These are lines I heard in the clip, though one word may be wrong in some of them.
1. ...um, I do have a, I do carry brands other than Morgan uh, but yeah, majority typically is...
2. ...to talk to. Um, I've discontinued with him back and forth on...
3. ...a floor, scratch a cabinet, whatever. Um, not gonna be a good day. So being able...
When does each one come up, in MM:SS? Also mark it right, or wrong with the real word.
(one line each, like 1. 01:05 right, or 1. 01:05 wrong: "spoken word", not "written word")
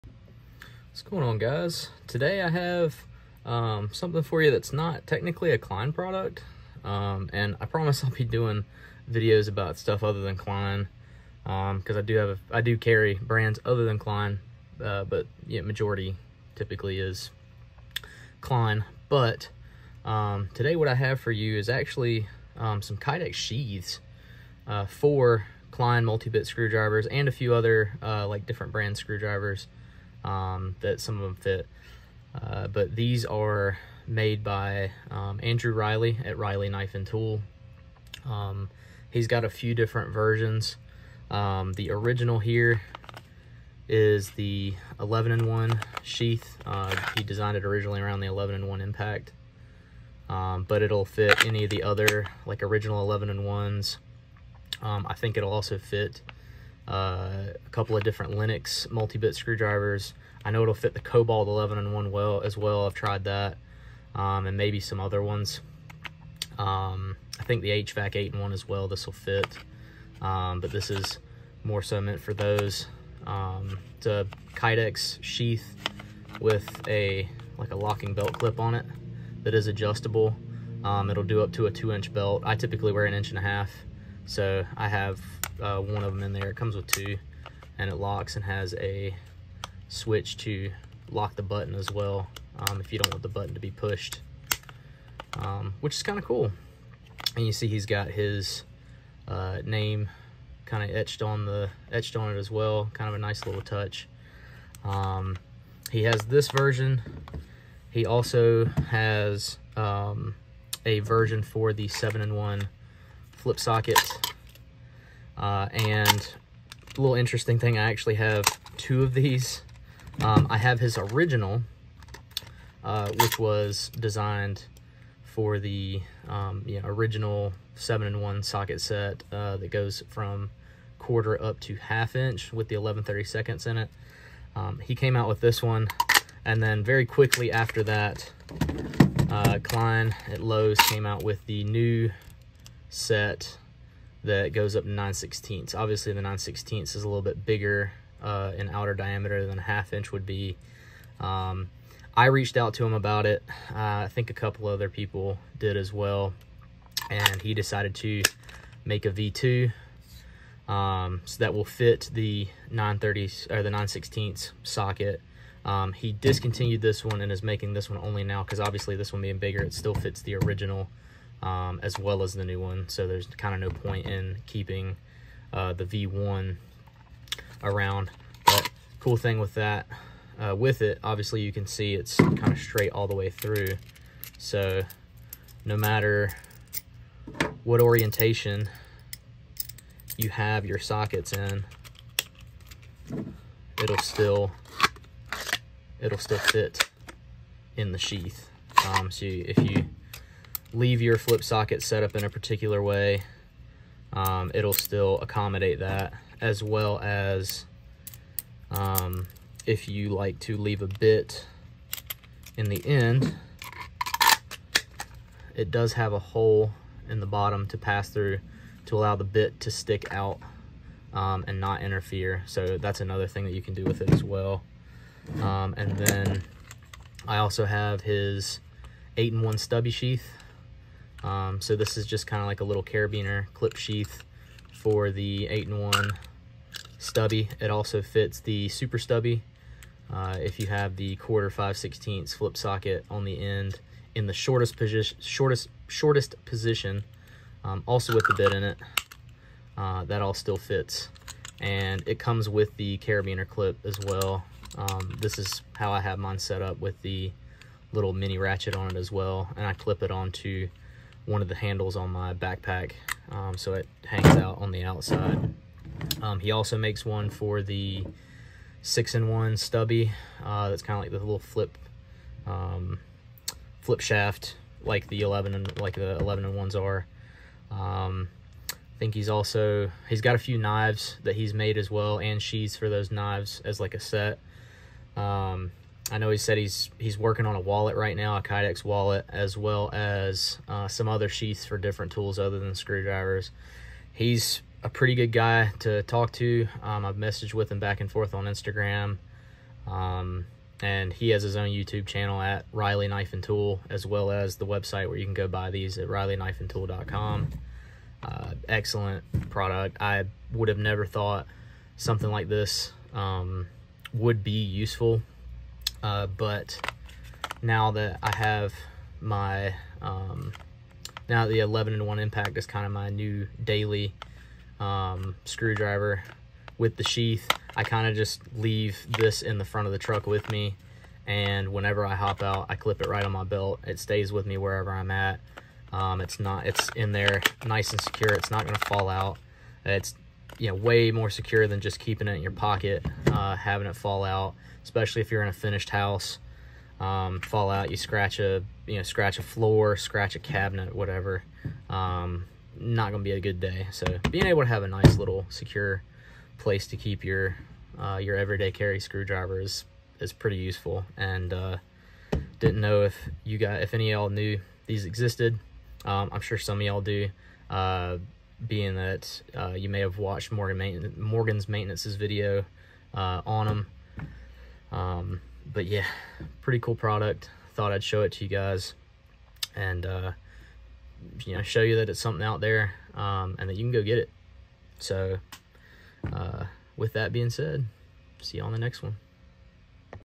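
1. 00:11 wrong: "Klein", not "Morgan"
2. 04:55 wrong: "messaged", not "discontinued"
3. 05:49 right.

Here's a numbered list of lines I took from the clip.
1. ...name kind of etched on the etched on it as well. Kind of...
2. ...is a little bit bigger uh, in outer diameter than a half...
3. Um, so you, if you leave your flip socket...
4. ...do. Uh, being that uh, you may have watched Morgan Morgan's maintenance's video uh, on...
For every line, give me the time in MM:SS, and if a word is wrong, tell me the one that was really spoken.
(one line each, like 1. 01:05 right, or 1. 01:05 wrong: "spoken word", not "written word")
1. 01:39 right
2. 02:26 right
3. 03:18 right
4. 06:07 right.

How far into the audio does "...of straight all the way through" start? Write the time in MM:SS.
03:02.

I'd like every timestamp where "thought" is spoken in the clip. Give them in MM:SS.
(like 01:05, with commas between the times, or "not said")
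05:11, 06:17.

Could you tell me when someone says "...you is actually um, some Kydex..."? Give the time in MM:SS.
00:21.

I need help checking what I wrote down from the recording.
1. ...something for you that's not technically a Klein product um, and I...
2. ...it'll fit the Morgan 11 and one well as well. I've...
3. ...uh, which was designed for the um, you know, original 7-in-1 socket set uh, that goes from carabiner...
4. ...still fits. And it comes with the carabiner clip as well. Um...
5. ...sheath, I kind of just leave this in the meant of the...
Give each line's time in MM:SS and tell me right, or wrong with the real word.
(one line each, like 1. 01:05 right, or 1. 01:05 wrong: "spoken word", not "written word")
1. 00:03 right
2. 01:00 wrong: "Kobalt", not "Morgan"
3. 02:02 wrong: "quarter", not "carabiner"
4. 04:10 right
5. 05:27 wrong: "front", not "meant".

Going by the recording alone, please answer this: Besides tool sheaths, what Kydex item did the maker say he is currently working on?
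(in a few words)
a wallet.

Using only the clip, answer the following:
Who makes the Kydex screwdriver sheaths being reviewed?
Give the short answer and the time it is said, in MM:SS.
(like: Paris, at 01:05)
Andrew Riley, at 00:35.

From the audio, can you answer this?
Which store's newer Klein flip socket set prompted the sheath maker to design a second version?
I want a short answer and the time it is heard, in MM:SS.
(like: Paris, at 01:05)
Lowe's, at 02:20.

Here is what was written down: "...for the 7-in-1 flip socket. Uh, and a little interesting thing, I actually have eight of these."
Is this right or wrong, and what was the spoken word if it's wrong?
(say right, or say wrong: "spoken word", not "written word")
wrong: "two", not "eight".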